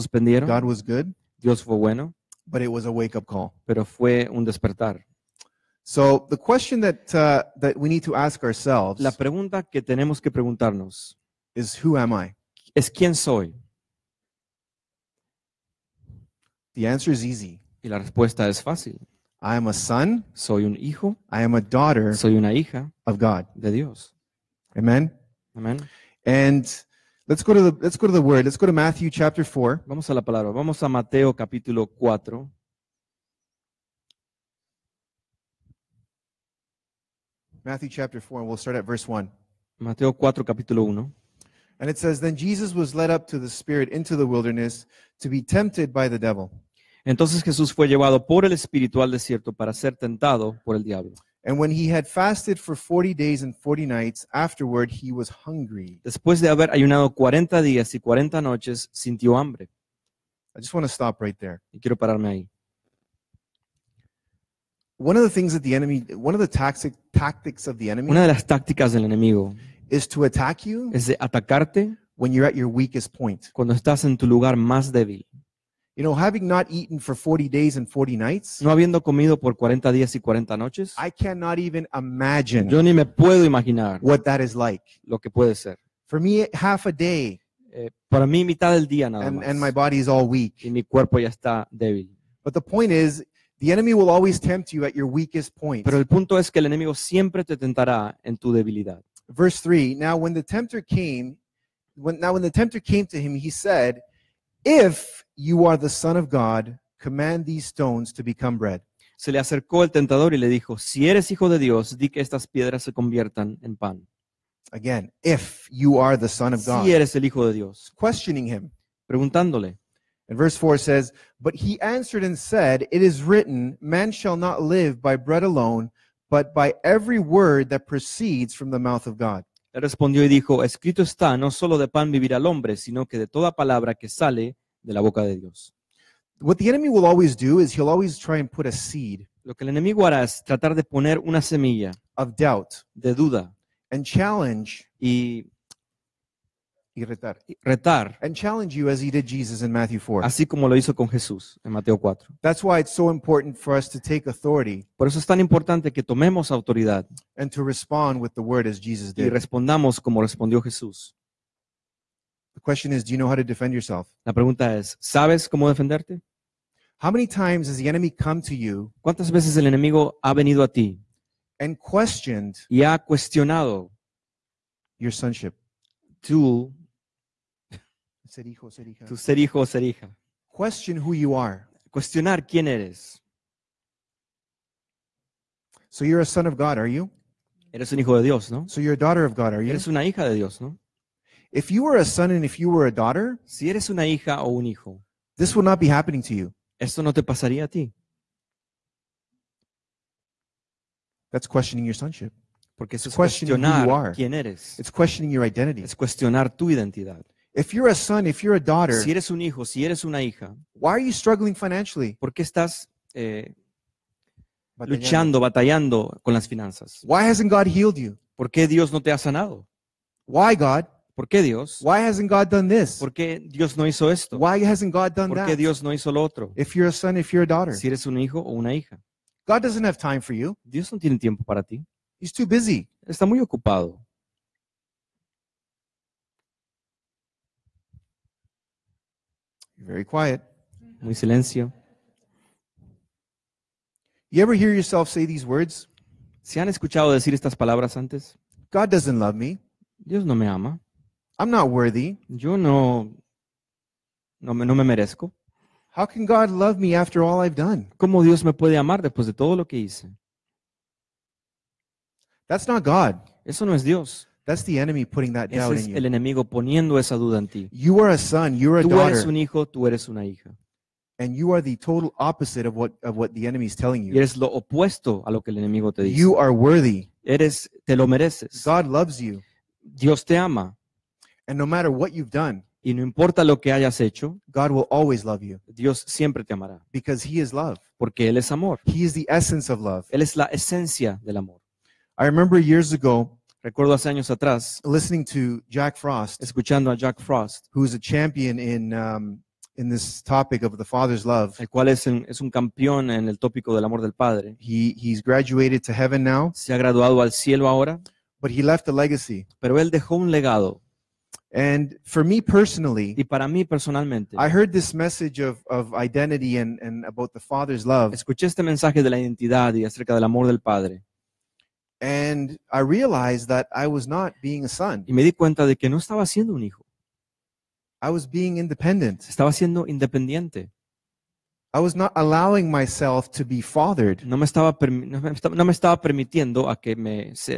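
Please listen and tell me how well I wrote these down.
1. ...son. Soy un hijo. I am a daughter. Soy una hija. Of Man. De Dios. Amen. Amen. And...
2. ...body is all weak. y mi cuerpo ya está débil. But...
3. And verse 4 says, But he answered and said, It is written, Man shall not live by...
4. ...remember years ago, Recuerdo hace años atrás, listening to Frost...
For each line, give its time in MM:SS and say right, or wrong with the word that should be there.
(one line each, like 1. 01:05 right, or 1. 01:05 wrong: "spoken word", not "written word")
1. 00:19 wrong: "God", not "Man"
2. 01:29 right
3. 02:00 right
4. 04:52 wrong: "Jack", not "Frost".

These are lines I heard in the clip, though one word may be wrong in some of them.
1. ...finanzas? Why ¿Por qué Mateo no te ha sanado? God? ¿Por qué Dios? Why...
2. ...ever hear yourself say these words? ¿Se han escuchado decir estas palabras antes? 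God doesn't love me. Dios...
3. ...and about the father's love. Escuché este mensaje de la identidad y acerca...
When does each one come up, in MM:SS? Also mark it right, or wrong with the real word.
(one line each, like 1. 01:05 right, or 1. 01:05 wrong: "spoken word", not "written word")
1. 03:36 wrong: "Dios", not "Mateo"
2. 04:04 right
3. 05:16 right.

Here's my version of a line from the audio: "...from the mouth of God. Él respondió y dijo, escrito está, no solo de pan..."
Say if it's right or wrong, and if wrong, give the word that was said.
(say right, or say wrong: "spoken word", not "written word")
right.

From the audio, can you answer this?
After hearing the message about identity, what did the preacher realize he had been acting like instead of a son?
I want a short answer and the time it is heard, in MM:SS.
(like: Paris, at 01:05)
independent, at 05:28.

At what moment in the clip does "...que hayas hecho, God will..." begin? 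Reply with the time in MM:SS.
04:43.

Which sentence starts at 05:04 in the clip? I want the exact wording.
He he's graduated to heaven now.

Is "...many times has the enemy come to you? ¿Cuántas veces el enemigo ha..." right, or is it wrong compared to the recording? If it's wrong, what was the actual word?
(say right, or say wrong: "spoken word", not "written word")
right.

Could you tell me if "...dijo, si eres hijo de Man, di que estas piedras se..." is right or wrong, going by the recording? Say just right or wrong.
wrong.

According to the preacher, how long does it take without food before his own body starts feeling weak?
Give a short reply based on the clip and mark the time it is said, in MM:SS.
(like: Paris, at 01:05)
half a day, at 01:26.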